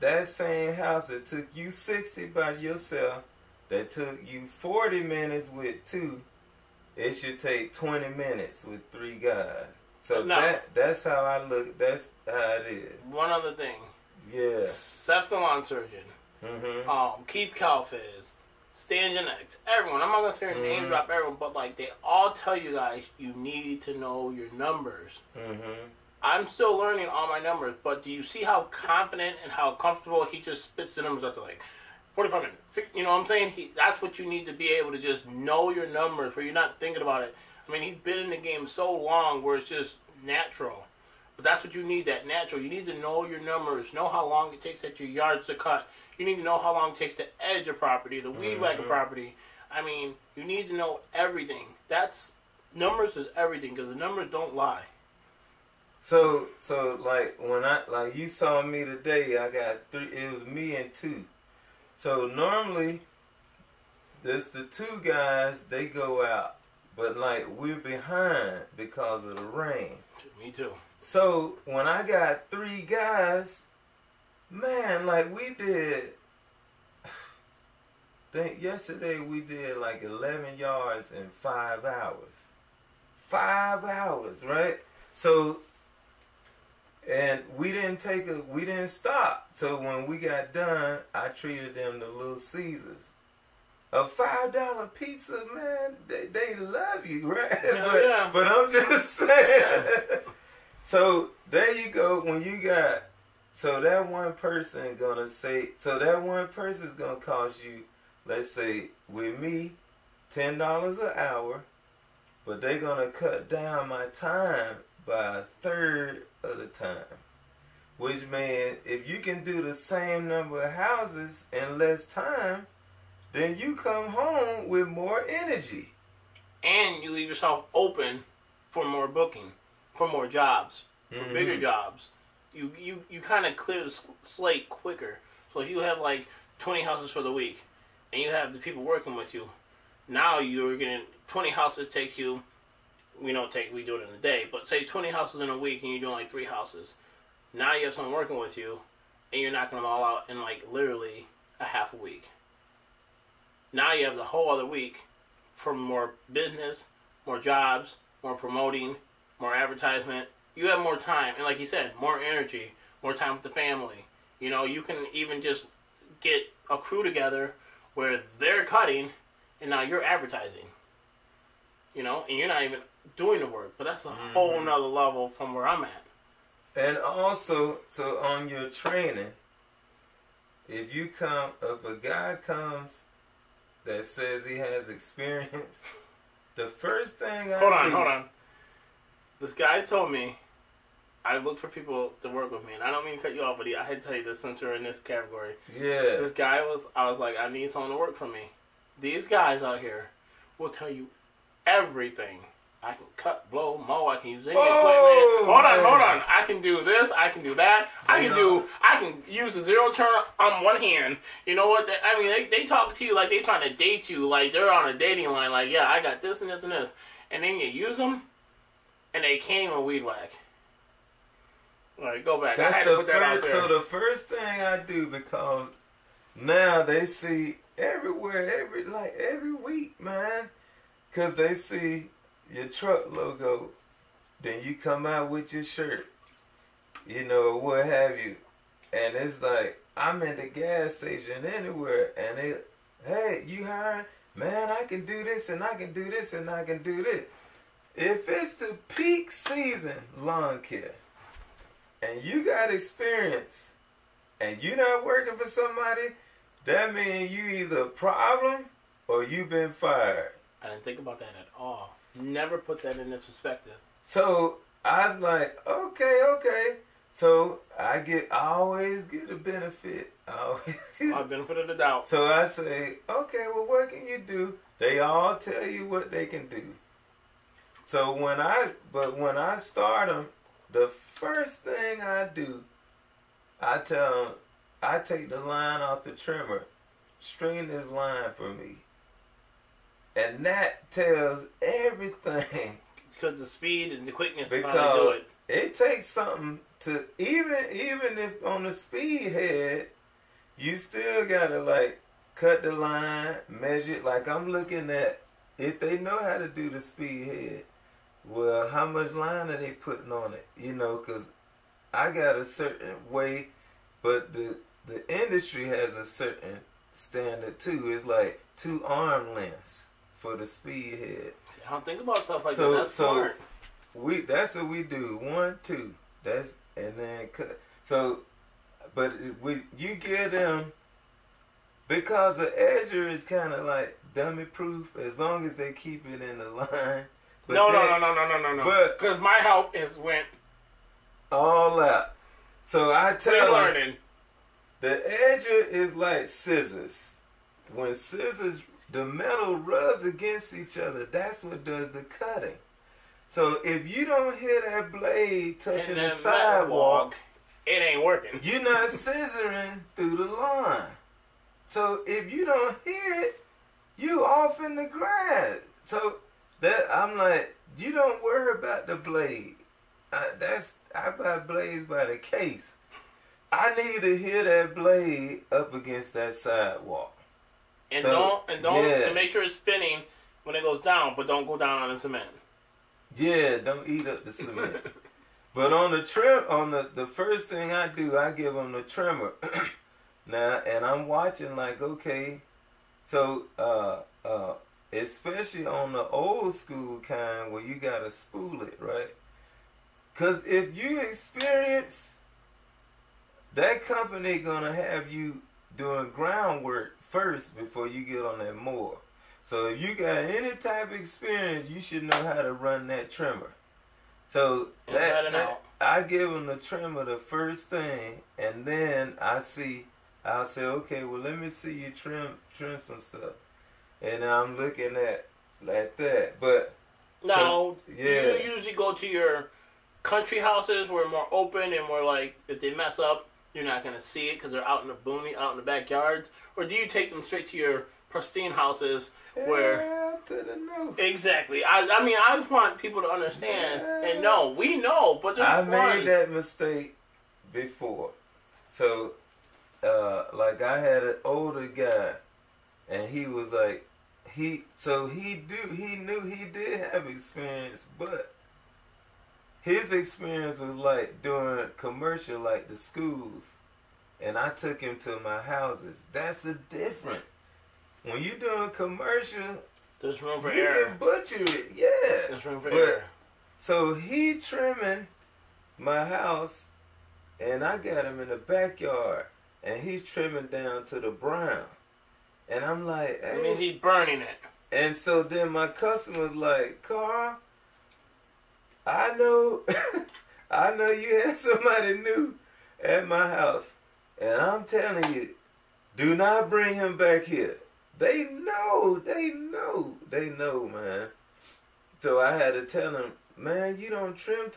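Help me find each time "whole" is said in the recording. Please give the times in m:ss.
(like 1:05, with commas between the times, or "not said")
2:34, 2:54.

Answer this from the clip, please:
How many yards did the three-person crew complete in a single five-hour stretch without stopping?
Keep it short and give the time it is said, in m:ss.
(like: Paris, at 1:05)
11, at 1:20.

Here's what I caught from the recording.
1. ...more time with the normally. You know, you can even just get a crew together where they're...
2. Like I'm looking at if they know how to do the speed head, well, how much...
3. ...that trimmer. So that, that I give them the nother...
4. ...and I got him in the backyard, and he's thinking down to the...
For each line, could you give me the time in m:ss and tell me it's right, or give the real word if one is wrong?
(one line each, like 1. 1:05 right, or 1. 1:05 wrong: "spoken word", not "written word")
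1. 2:43 wrong: "family", not "normally"
2. 5:04 right
3. 6:52 wrong: "trimmer", not "nother"
4. 7:57 wrong: "trimming", not "thinking".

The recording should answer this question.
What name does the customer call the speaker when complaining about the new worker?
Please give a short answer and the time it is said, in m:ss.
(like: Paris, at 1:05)
Carl, at 8:06.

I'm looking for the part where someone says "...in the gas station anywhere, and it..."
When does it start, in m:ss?
4:00.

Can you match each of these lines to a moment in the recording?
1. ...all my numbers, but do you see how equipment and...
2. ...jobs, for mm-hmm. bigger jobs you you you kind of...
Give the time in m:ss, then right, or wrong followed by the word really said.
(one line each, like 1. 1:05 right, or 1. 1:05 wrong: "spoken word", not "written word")
1. 0:27 wrong: "confident", not "equipment"
2. 2:10 right.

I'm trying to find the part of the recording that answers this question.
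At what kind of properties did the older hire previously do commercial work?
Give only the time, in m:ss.
7:42.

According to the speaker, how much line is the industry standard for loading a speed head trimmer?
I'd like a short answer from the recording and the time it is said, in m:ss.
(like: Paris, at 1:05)
Two arm lengths, at 5:18.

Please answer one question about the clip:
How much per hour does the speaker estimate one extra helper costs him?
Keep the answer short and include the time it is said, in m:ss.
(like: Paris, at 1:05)
10 dollars, at 1:50.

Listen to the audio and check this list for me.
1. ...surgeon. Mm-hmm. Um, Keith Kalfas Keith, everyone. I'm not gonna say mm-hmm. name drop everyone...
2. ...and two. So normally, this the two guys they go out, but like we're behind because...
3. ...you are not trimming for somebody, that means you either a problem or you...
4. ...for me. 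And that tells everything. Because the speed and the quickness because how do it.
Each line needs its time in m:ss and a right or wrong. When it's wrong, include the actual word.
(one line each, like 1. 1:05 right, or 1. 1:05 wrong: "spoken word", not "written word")
1. 0:15 wrong: "Stangenix", not "Keith"
2. 1:00 right
3. 4:14 wrong: "working", not "trimming"
4. 4:48 right.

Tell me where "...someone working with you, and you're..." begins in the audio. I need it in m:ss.
2:27.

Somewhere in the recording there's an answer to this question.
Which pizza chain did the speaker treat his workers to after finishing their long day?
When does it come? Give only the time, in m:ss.
1:32.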